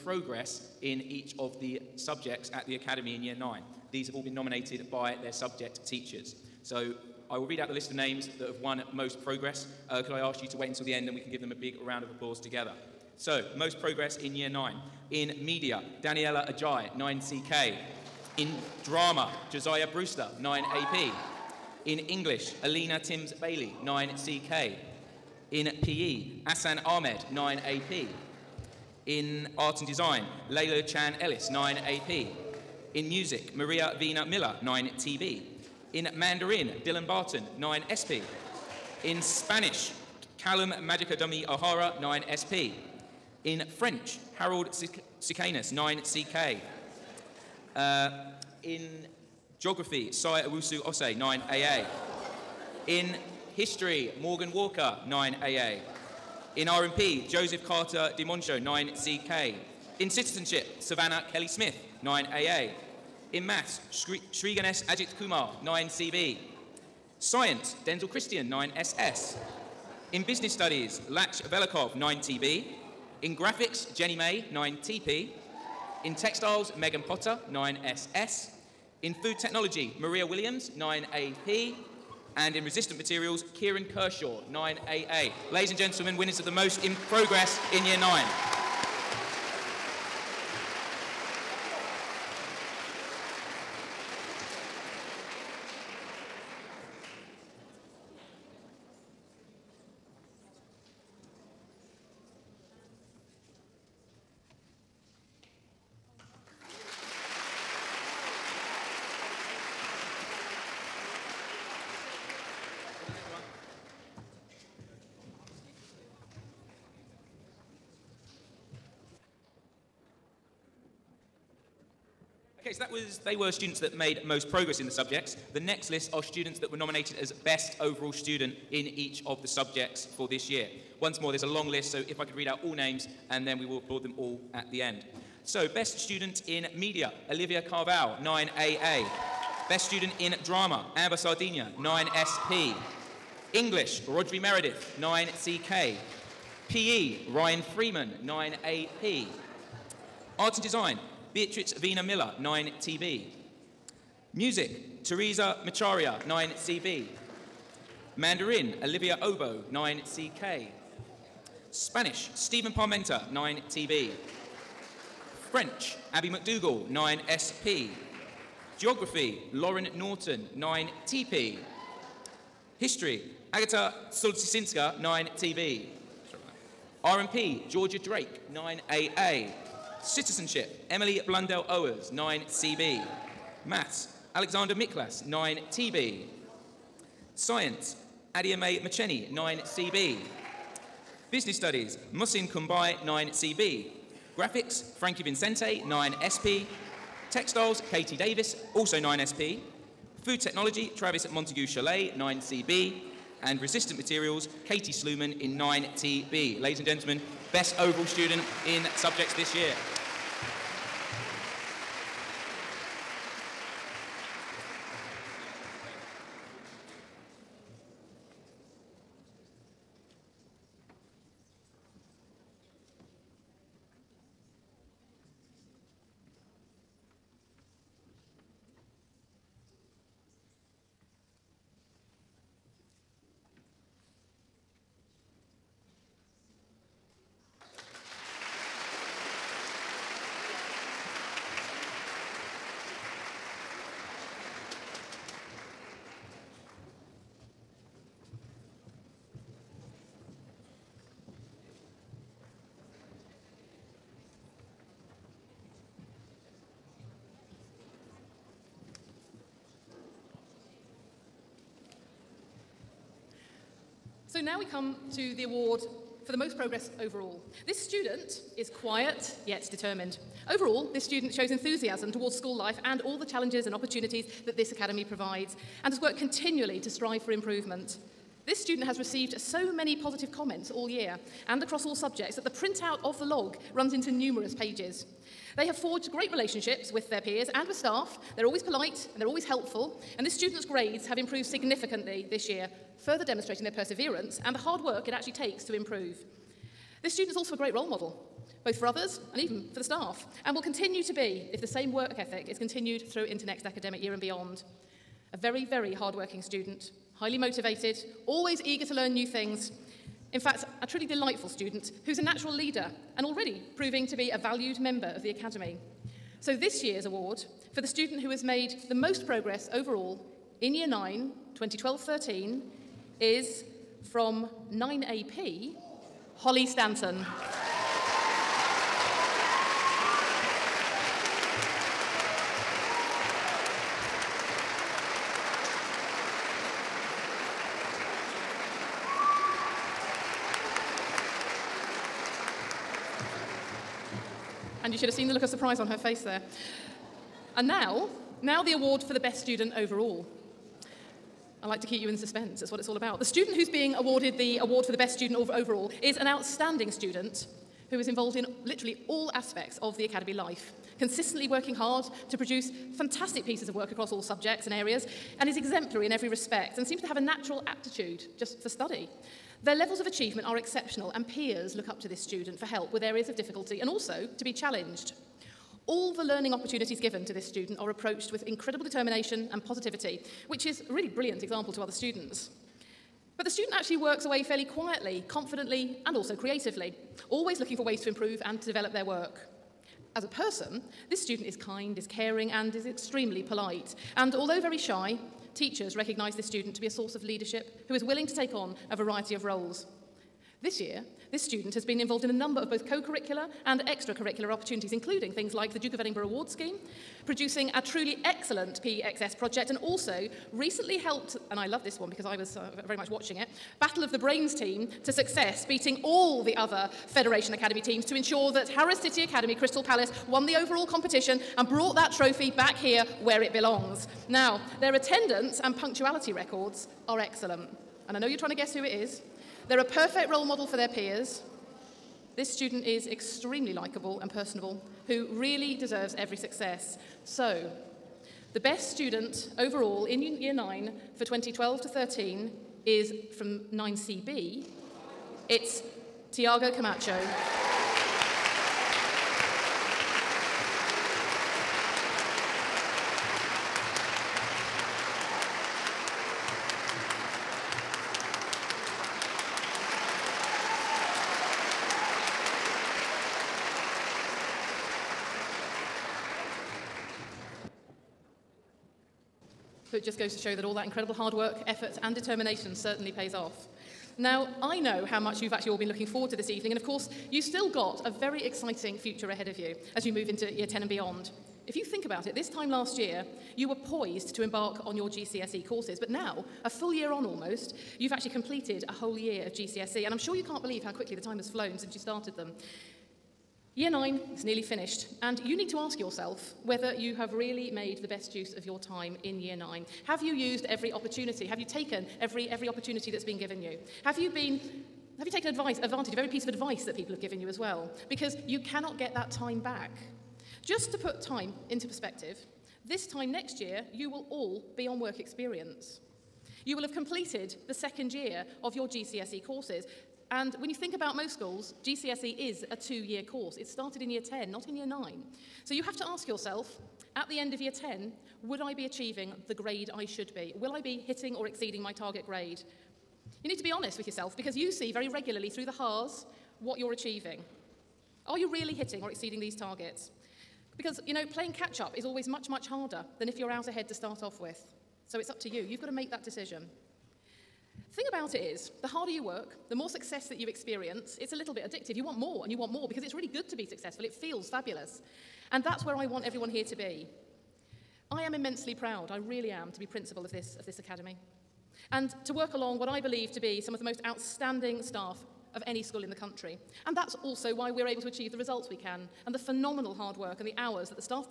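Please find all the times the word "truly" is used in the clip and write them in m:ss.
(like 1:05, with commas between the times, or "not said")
5:10, 6:47.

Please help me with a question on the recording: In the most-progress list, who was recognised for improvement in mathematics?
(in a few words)
Shri Ajit Kumar.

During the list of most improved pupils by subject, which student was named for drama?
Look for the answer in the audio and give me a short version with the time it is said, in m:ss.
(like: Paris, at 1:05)
Josiah Brewster, at 0:19.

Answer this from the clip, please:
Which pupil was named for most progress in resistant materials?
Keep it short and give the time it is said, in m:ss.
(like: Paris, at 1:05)
Kieran Kershaw, at 1:23.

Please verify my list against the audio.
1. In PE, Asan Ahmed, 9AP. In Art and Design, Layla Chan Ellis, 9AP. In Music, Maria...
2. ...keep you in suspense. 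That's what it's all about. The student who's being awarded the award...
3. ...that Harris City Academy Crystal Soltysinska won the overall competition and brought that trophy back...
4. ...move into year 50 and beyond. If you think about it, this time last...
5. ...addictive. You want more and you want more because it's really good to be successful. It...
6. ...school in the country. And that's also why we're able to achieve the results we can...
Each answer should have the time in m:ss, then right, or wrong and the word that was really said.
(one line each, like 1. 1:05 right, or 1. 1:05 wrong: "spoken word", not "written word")
1. 0:25 right
2. 5:51 right
3. 6:58 wrong: "Palace", not "Soltysinska"
4. 8:00 wrong: "10", not "50"
5. 9:11 right
6. 9:25 right.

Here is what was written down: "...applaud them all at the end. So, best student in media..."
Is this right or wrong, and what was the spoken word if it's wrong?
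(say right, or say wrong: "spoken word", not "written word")
right.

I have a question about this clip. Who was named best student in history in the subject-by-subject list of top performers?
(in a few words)
Agata Soltysinska.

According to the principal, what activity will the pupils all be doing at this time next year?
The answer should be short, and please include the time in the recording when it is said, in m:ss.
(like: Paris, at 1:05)
Work experience, at 8:34.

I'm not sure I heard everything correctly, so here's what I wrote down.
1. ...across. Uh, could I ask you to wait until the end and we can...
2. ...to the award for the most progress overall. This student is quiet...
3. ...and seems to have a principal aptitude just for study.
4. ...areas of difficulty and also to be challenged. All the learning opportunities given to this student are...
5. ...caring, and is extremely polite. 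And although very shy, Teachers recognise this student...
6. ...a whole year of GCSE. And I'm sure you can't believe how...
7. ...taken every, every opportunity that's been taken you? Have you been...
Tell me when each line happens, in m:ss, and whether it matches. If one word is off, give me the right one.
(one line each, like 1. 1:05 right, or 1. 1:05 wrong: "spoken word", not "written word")
1. 0:09 wrong: "progress", not "across"
2. 4:25 right
3. 6:06 wrong: "natural", not "principal"
4. 6:13 right
5. 6:32 right
6. 8:08 right
7. 8:21 wrong: "given", not "taken".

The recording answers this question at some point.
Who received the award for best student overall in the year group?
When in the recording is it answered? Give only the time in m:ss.
7:26.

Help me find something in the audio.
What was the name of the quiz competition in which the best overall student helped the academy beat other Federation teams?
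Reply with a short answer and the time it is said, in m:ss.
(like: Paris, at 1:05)
Battle of the Brains, at 6:53.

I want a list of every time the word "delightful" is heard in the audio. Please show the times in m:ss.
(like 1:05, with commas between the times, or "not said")
5:11.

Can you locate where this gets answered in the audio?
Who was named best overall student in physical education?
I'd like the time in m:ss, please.
2:27.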